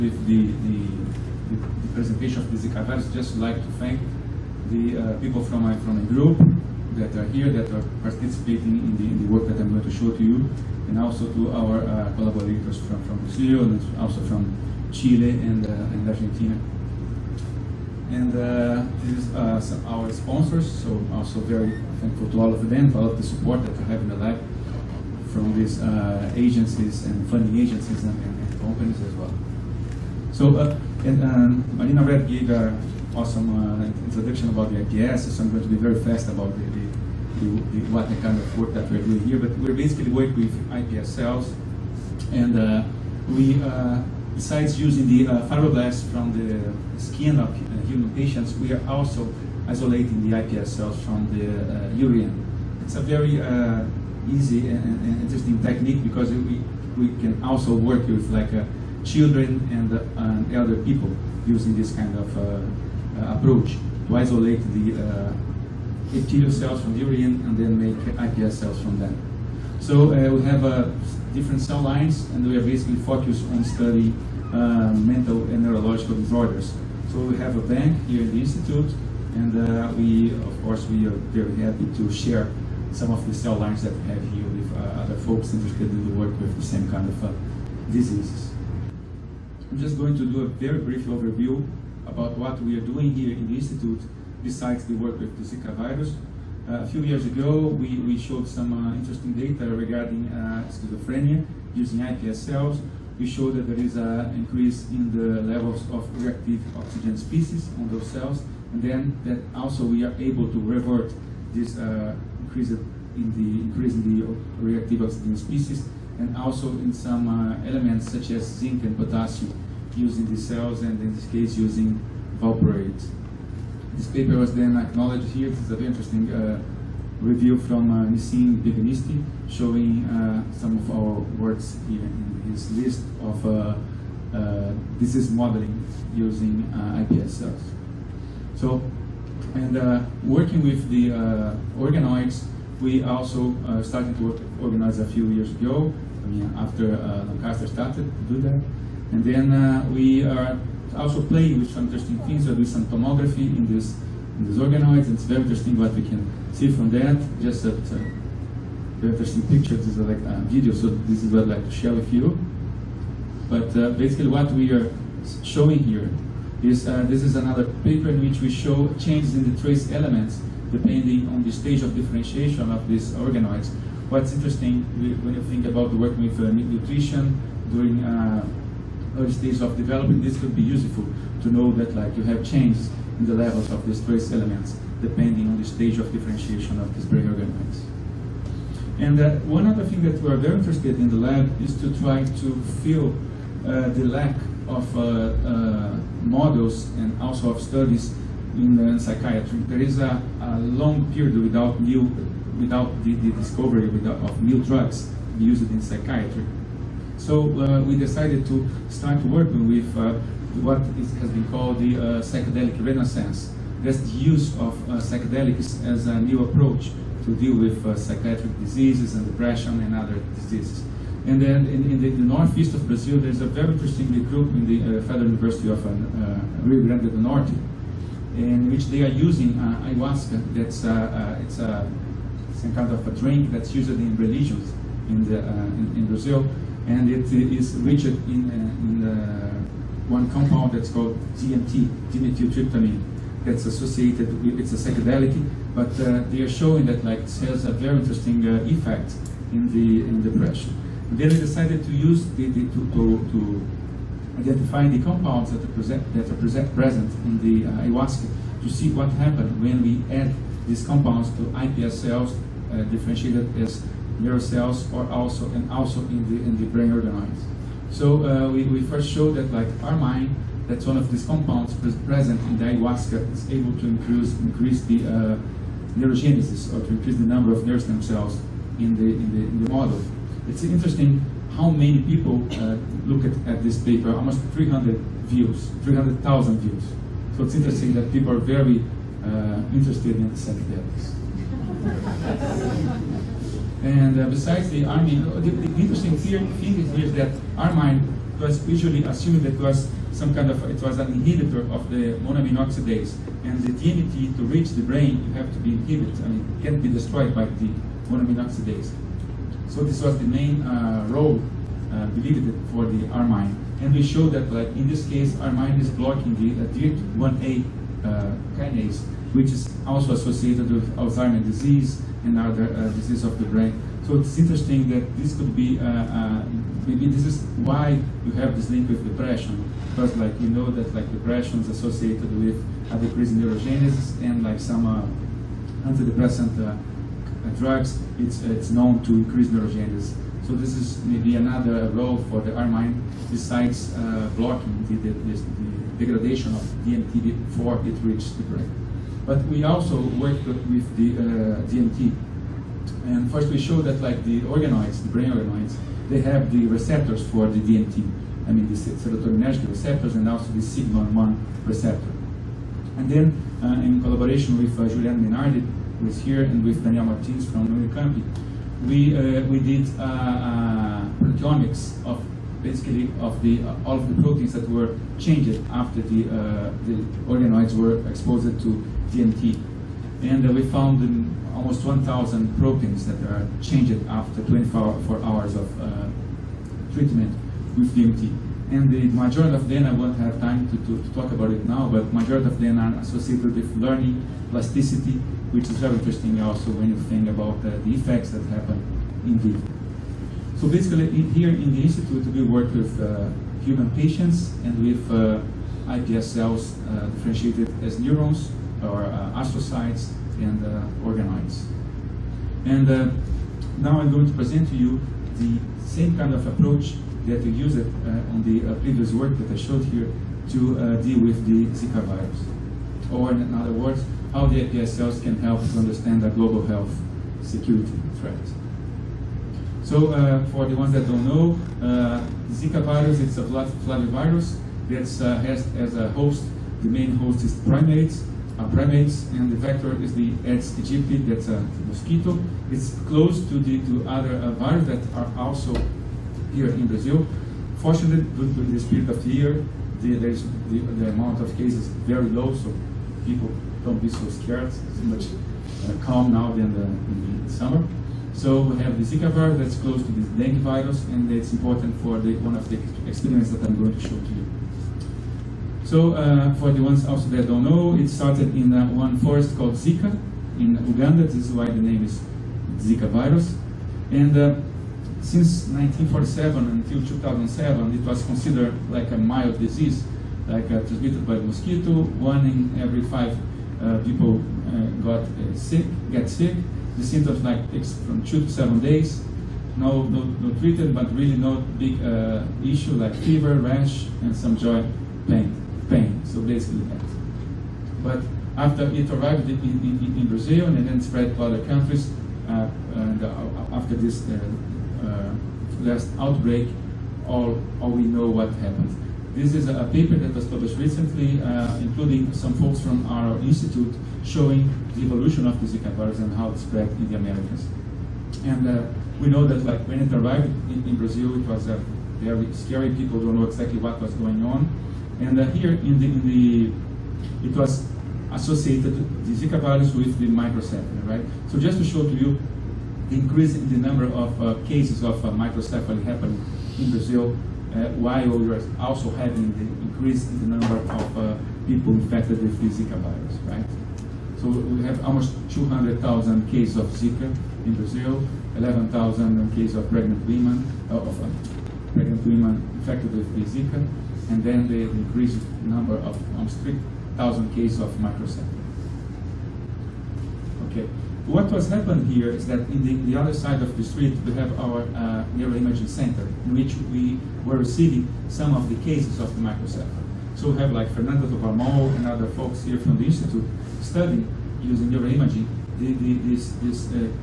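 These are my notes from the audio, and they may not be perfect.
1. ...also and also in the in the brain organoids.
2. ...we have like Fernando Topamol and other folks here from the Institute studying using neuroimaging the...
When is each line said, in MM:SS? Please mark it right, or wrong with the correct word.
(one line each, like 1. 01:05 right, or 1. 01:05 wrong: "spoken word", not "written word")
1. 04:25 right
2. 09:30 right.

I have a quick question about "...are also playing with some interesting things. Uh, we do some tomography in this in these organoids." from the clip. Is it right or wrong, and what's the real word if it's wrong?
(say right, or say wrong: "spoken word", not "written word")
right.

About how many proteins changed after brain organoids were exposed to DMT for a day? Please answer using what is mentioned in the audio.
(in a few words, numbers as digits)
1,000.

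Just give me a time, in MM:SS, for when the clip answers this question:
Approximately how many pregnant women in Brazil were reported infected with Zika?
09:08.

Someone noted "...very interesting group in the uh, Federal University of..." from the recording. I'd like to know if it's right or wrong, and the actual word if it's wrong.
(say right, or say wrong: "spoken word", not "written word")
right.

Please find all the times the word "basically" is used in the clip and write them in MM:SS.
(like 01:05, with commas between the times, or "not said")
00:39, 01:12, 02:43, 06:12, 06:40, 08:16.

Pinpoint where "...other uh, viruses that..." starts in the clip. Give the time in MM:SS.
07:24.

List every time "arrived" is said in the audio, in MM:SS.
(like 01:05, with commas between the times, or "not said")
08:19, 08:40.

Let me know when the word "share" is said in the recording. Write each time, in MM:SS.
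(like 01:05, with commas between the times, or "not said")
01:22, 02:41.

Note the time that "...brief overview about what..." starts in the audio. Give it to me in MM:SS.
01:30.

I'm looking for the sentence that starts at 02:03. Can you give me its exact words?
This paper was then acknowledged here.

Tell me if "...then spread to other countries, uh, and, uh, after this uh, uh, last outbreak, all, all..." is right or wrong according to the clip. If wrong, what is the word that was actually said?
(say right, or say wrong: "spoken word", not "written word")
right.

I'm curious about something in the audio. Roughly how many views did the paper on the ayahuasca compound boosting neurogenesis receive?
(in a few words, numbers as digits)
300,000.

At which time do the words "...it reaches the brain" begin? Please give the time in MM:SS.
05:47.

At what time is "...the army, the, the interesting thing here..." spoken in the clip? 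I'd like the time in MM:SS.
04:54.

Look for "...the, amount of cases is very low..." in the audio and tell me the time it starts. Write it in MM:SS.
07:30.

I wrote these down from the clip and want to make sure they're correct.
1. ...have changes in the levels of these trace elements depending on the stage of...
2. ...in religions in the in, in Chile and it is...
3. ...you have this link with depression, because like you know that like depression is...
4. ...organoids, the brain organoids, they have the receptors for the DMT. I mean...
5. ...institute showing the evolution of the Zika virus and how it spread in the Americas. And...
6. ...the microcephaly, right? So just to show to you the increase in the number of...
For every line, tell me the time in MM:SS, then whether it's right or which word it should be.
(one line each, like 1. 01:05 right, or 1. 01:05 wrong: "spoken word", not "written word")
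1. 03:02 right
2. 03:53 wrong: "Brazil", not "Chile"
3. 05:28 right
4. 05:54 right
5. 08:33 right
6. 08:50 right.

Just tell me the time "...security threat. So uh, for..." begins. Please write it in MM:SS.
07:07.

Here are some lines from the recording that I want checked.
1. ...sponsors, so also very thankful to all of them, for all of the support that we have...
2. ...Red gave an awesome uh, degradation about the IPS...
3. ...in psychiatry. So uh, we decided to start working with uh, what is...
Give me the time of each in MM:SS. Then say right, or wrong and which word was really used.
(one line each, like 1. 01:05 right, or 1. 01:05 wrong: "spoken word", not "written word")
1. 00:20 right
2. 00:32 wrong: "introduction", not "degradation"
3. 03:25 right.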